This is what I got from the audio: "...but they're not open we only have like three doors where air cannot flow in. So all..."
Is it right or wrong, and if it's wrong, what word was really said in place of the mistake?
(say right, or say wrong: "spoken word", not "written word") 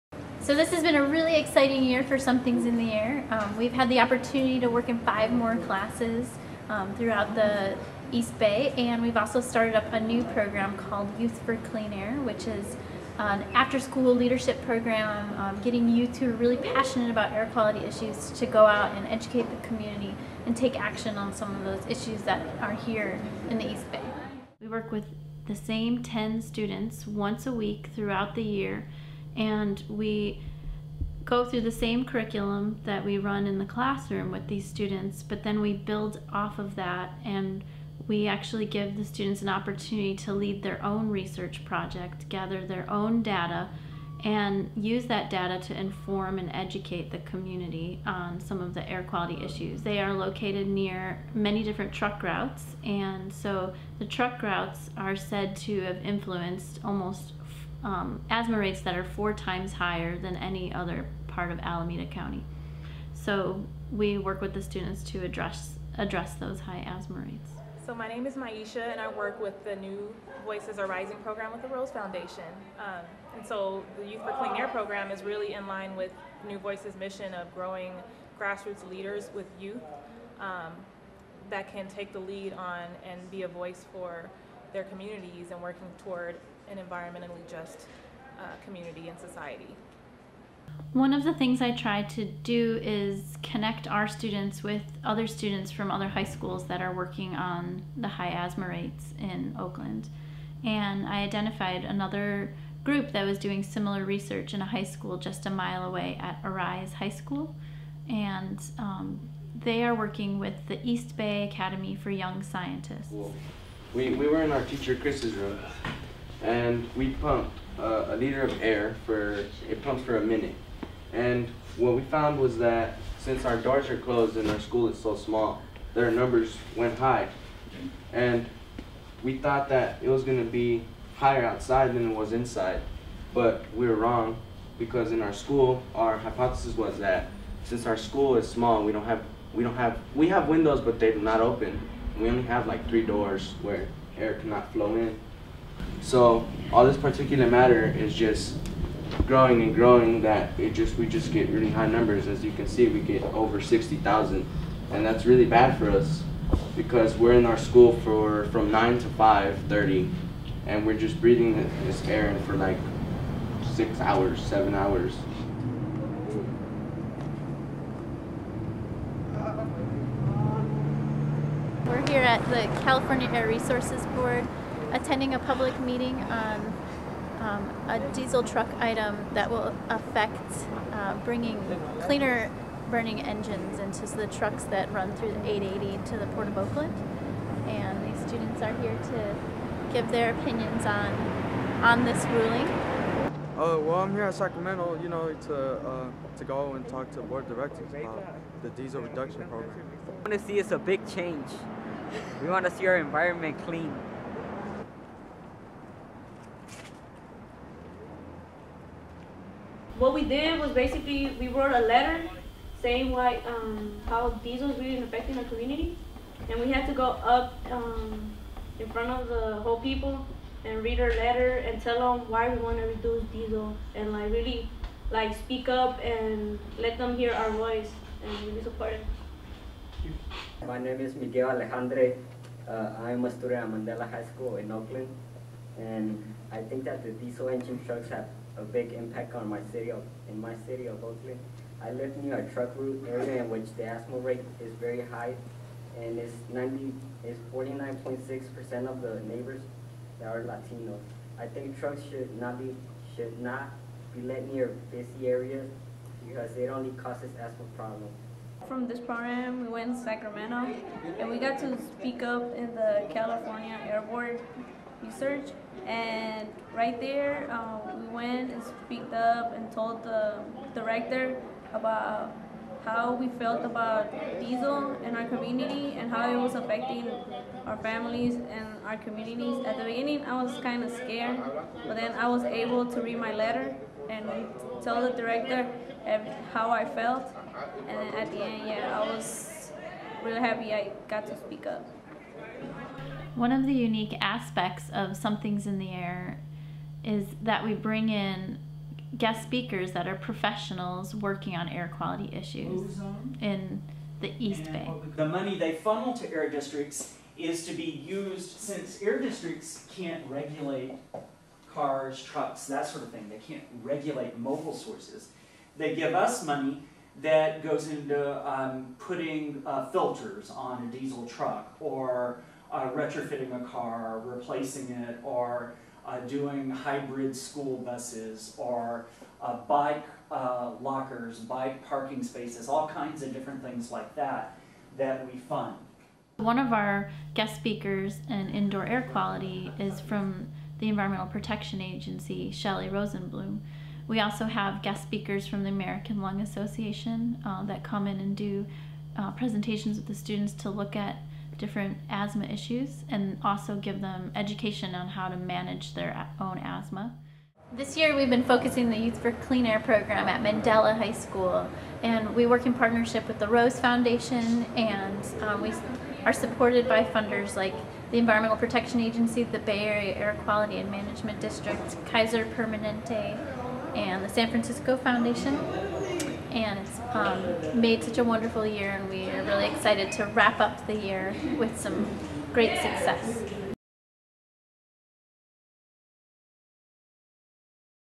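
right.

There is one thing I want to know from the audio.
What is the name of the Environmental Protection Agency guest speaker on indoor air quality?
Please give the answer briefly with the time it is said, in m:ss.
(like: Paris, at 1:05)
Shelley Rosenblum, at 5:42.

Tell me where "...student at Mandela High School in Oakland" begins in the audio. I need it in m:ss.
3:53.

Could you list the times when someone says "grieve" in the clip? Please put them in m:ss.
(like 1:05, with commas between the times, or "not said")
not said.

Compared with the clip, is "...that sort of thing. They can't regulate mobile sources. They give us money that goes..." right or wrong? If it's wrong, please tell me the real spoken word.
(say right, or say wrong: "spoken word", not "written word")
right.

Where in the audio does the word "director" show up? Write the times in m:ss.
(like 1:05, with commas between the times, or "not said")
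3:17, 4:30, 4:45.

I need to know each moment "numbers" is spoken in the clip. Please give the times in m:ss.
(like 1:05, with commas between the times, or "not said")
2:06, 2:31.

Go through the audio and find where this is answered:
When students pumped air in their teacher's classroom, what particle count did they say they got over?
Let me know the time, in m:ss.
2:33.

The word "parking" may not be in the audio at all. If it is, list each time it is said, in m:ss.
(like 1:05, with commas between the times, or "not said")
5:31.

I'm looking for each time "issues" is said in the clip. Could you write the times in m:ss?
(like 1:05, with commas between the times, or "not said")
0:17, 0:21, 0:49, 5:02, 5:52.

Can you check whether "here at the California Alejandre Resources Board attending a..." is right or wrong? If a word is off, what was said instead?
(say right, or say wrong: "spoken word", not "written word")
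wrong: "Air", not "Alejandre".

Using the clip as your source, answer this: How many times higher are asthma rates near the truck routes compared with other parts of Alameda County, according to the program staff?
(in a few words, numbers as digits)
4.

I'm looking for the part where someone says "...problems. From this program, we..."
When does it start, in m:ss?
4:17.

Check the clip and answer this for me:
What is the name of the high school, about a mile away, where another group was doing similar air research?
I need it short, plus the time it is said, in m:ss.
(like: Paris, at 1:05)
Arise High School, at 1:46.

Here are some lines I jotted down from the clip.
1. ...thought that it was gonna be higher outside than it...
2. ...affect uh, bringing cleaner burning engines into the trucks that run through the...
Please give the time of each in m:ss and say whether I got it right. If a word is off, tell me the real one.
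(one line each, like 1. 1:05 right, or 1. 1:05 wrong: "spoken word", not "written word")
1. 2:09 right
2. 2:59 right.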